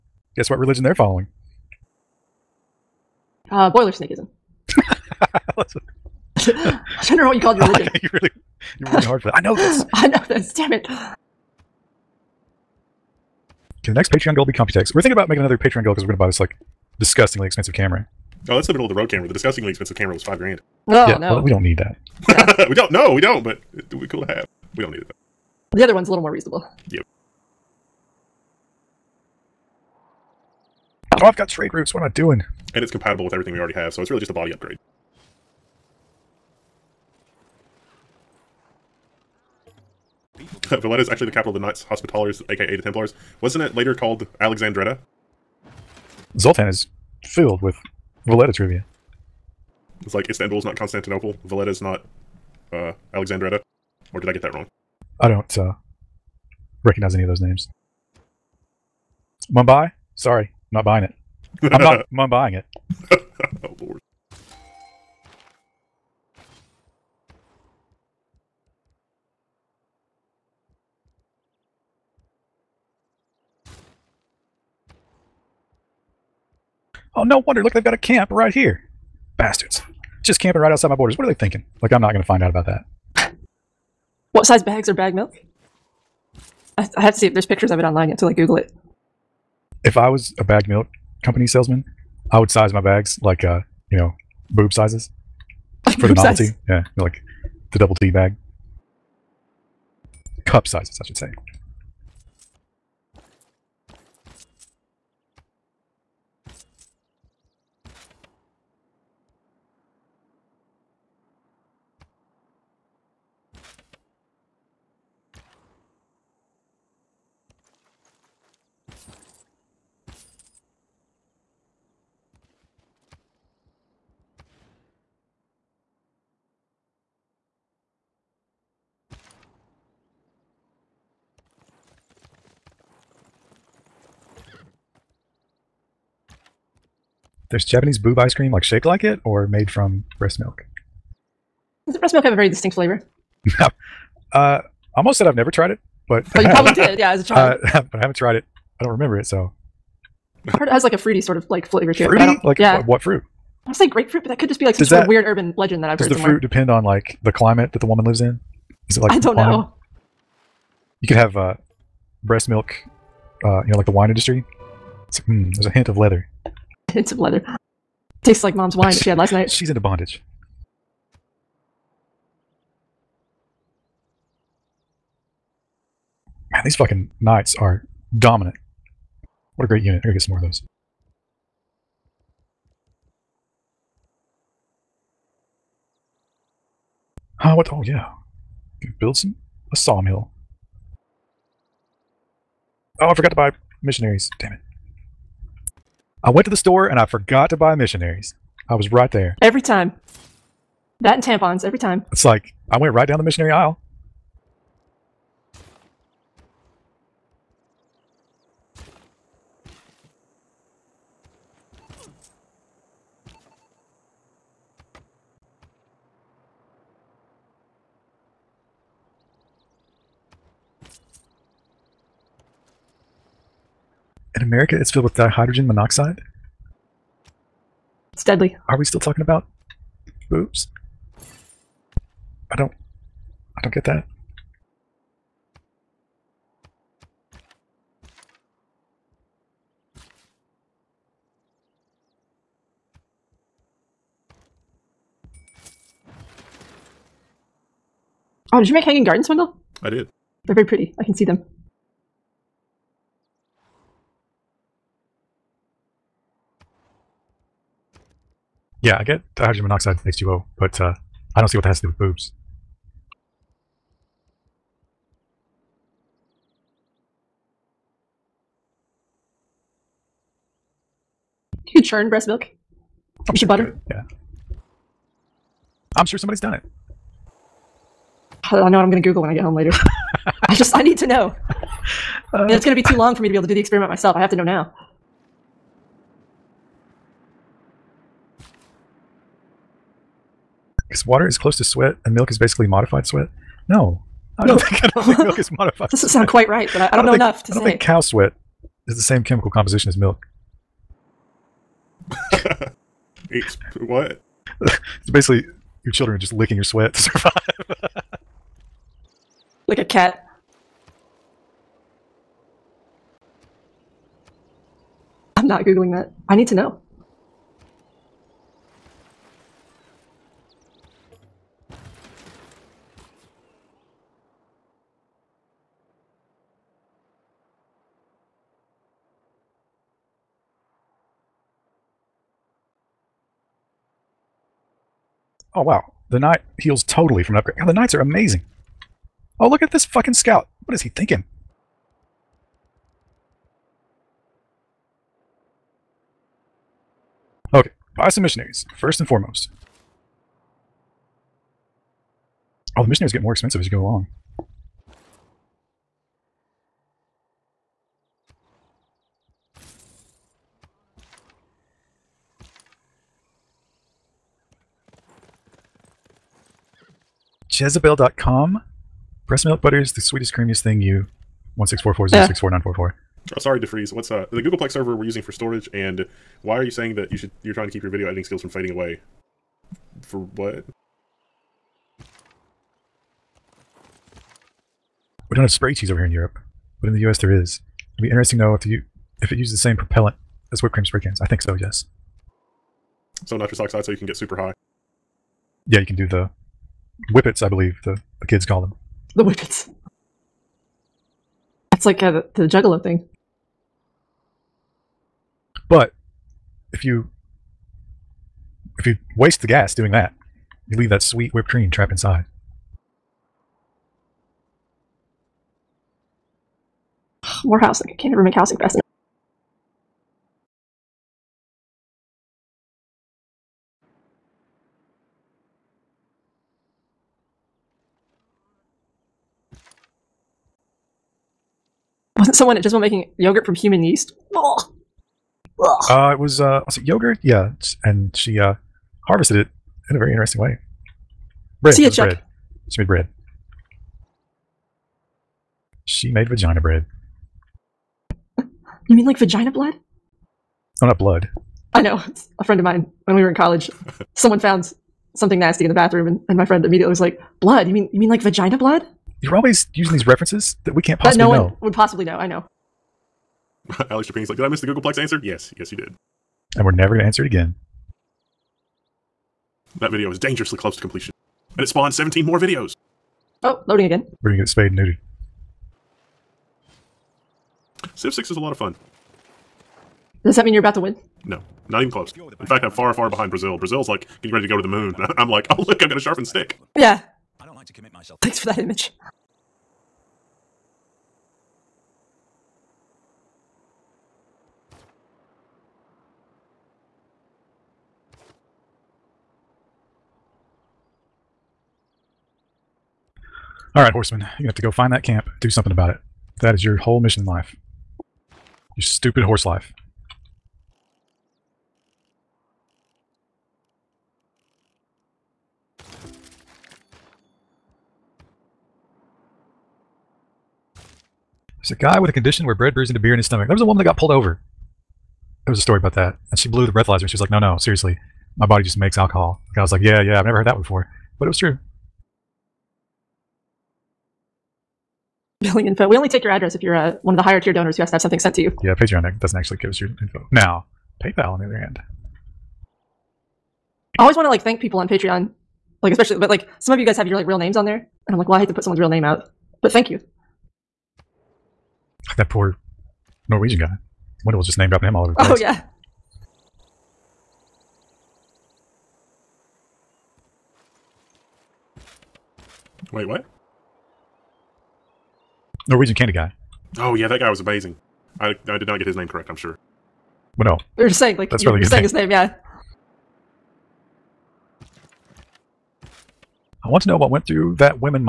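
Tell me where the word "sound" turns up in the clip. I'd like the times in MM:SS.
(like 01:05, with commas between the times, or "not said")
04:56.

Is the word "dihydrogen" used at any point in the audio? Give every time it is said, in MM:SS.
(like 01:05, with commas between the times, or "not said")
03:45, 04:19.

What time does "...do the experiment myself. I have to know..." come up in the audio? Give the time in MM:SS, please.
04:43.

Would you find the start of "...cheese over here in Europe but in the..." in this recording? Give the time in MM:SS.
06:25.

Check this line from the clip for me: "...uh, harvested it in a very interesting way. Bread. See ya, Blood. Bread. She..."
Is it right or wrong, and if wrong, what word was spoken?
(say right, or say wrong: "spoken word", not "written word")
wrong: "Chuck", not "Blood".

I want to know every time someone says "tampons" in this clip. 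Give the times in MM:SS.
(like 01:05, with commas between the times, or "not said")
03:21.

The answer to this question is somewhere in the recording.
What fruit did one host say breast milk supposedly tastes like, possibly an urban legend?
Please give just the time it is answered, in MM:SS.
02:33.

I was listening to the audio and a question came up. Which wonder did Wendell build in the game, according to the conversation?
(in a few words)
hanging gardens.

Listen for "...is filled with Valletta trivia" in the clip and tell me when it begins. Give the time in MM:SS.
00:46.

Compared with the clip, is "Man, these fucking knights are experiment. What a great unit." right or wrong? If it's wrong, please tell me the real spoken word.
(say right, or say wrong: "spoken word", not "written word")
wrong: "dominant", not "experiment".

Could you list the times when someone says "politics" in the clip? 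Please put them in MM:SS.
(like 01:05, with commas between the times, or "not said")
not said.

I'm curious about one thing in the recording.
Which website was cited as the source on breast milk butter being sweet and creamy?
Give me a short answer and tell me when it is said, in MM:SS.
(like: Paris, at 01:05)
Jezebel.com, at 06:07.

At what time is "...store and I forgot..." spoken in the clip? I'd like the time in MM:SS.
03:16.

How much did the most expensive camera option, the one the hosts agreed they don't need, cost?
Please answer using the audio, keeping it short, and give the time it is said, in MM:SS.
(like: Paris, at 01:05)
5 grand, at 00:20.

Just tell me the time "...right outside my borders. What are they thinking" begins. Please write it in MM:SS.
01:20.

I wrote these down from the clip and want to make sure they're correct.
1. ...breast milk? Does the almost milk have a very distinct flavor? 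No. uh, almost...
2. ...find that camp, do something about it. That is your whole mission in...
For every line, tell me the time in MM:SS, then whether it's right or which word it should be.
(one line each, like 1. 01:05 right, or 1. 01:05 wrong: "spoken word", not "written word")
1. 02:20 wrong: "breast", not "almost"
2. 08:24 right.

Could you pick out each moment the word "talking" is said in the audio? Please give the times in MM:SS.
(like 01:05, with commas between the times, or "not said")
03:48.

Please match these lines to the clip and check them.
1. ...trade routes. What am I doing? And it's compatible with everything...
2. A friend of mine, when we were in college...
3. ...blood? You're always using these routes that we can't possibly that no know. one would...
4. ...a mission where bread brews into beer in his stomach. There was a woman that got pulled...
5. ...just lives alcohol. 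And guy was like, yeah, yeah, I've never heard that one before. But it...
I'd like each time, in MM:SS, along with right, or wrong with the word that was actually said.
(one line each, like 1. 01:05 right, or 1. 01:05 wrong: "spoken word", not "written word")
1. 00:31 right
2. 07:32 right
3. 07:38 wrong: "references", not "routes"
4. 08:42 wrong: "condition", not "mission"
5. 08:48 wrong: "makes", not "lives".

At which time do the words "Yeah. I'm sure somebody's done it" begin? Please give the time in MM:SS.
04:33.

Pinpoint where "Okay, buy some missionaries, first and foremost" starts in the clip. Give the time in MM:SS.
05:47.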